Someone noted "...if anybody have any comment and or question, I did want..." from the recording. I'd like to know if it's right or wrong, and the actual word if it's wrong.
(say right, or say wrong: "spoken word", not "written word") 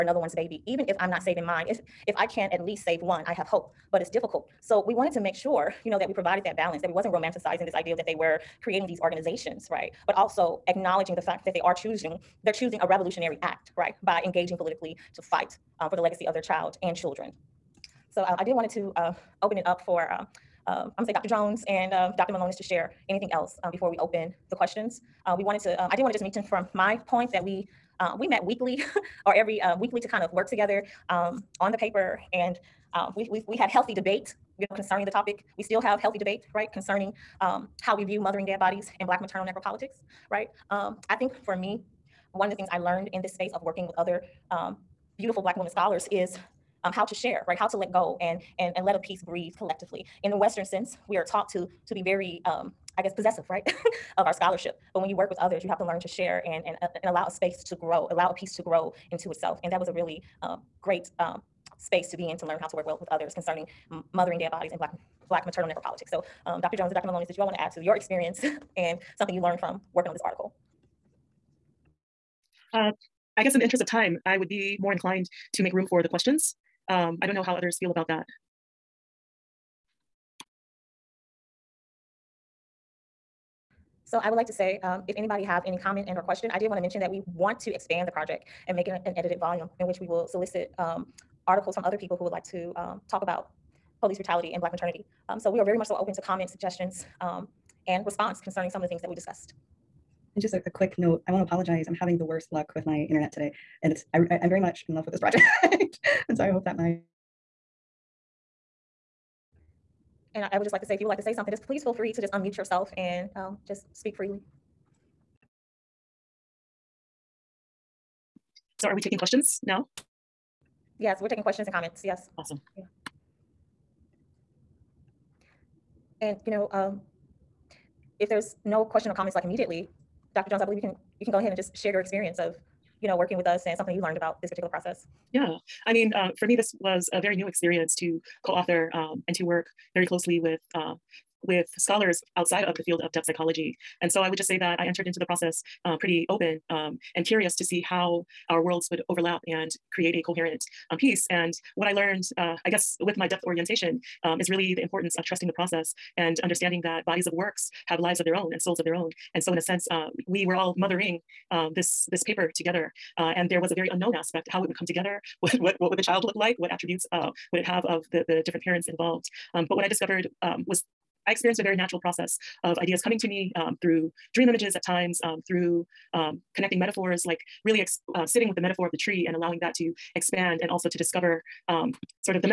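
right.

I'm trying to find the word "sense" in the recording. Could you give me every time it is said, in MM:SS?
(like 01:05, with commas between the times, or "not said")
00:50, 02:39.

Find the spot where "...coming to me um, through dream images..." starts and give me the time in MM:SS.
02:53.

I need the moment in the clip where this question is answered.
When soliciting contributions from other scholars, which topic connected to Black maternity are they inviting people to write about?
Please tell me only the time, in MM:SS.
01:34.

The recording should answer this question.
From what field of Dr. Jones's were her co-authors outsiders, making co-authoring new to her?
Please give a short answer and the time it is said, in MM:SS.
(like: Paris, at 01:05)
depth psychology, at 02:23.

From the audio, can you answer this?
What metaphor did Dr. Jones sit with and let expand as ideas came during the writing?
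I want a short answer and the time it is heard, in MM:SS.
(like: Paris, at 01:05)
the tree, at 02:58.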